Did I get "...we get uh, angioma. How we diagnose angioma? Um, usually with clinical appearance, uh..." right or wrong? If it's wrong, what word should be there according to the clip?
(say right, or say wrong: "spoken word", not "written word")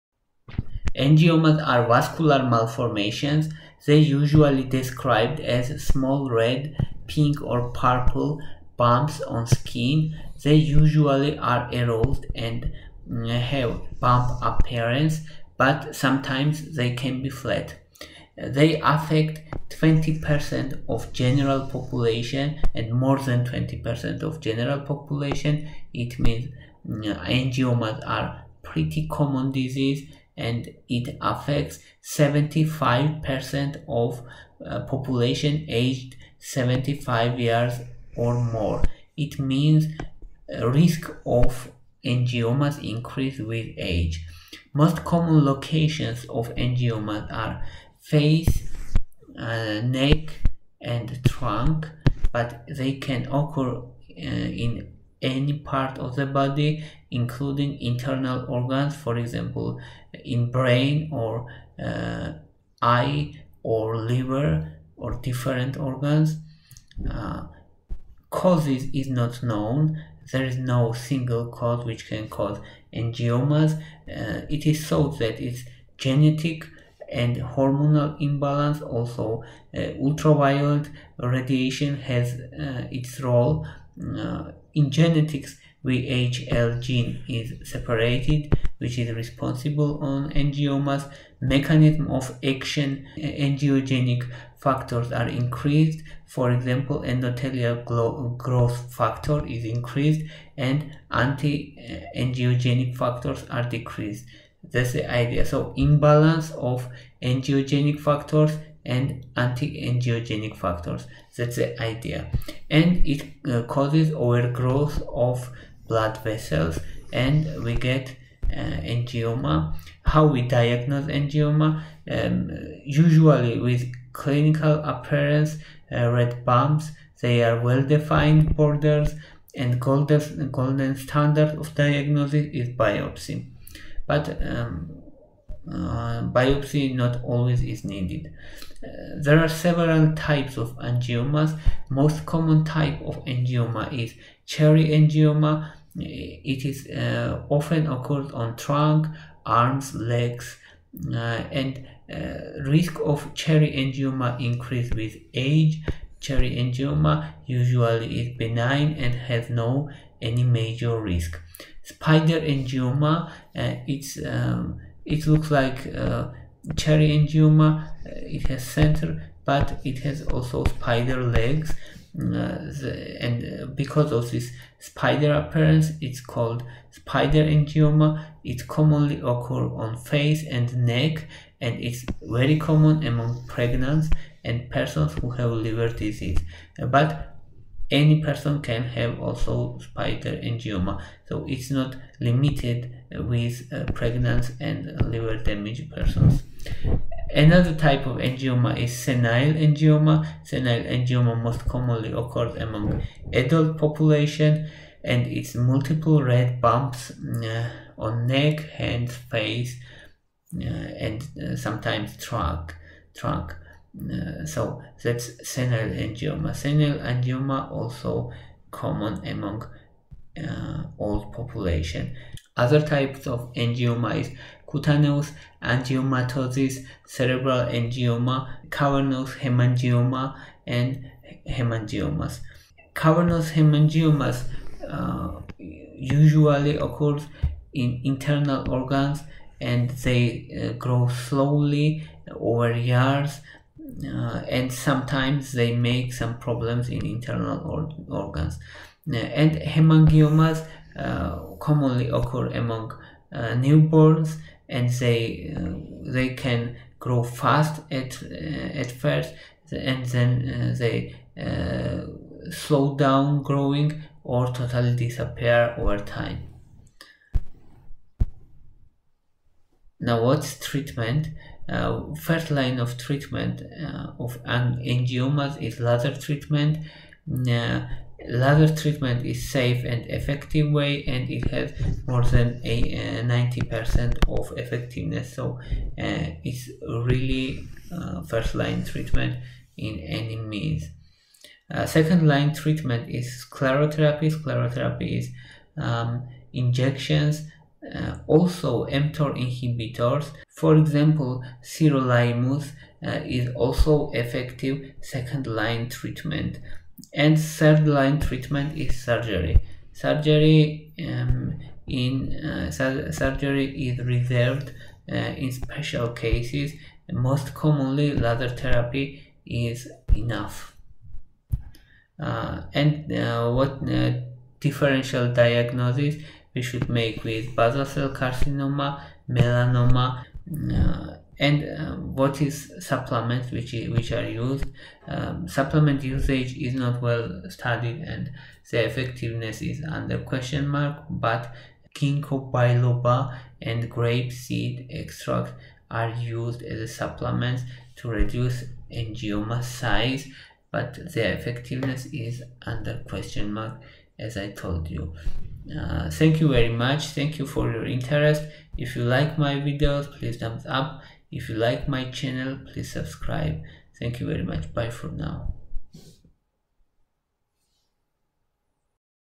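right.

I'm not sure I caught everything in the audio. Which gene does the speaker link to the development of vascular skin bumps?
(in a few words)
VHL.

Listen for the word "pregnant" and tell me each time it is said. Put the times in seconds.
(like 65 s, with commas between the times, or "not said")
183 s, 193 s.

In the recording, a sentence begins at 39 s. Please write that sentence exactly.
It means uh, risk of angiomas increase with age.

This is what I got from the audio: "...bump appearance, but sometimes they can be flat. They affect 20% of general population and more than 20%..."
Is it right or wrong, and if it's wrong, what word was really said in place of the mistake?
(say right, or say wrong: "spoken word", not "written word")
right.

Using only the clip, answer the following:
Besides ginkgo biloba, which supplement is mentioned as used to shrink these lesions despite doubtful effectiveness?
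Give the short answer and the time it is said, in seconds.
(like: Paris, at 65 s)
grape seed extract, at 343 s.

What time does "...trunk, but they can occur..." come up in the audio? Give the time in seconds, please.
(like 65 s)
51 s.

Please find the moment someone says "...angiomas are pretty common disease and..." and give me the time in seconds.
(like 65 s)
27 s.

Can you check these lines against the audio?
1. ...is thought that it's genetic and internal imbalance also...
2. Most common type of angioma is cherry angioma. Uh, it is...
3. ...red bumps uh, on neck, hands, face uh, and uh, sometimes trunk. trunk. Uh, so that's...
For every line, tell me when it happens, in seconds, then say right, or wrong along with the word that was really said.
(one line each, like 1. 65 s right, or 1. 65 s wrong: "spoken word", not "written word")
1. 74 s wrong: "hormonal", not "internal"
2. 141 s right
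3. 206 s right.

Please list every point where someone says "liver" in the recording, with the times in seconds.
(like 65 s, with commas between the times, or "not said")
63 s, 185 s, 195 s.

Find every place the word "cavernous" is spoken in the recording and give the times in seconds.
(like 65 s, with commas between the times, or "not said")
228 s, 232 s.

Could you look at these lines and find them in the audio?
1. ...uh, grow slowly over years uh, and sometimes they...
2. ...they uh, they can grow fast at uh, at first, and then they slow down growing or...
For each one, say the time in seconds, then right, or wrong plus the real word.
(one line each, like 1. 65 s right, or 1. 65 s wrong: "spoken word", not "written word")
1. 240 s right
2. 254 s right.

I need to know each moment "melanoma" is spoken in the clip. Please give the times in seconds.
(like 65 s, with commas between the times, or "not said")
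329 s.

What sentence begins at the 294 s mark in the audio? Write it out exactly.
Sclerotherapy is um, injections, also mTOR inhibitors for example, sirolimus uh, is also effective second-line treatment and third-line treatment is surgery.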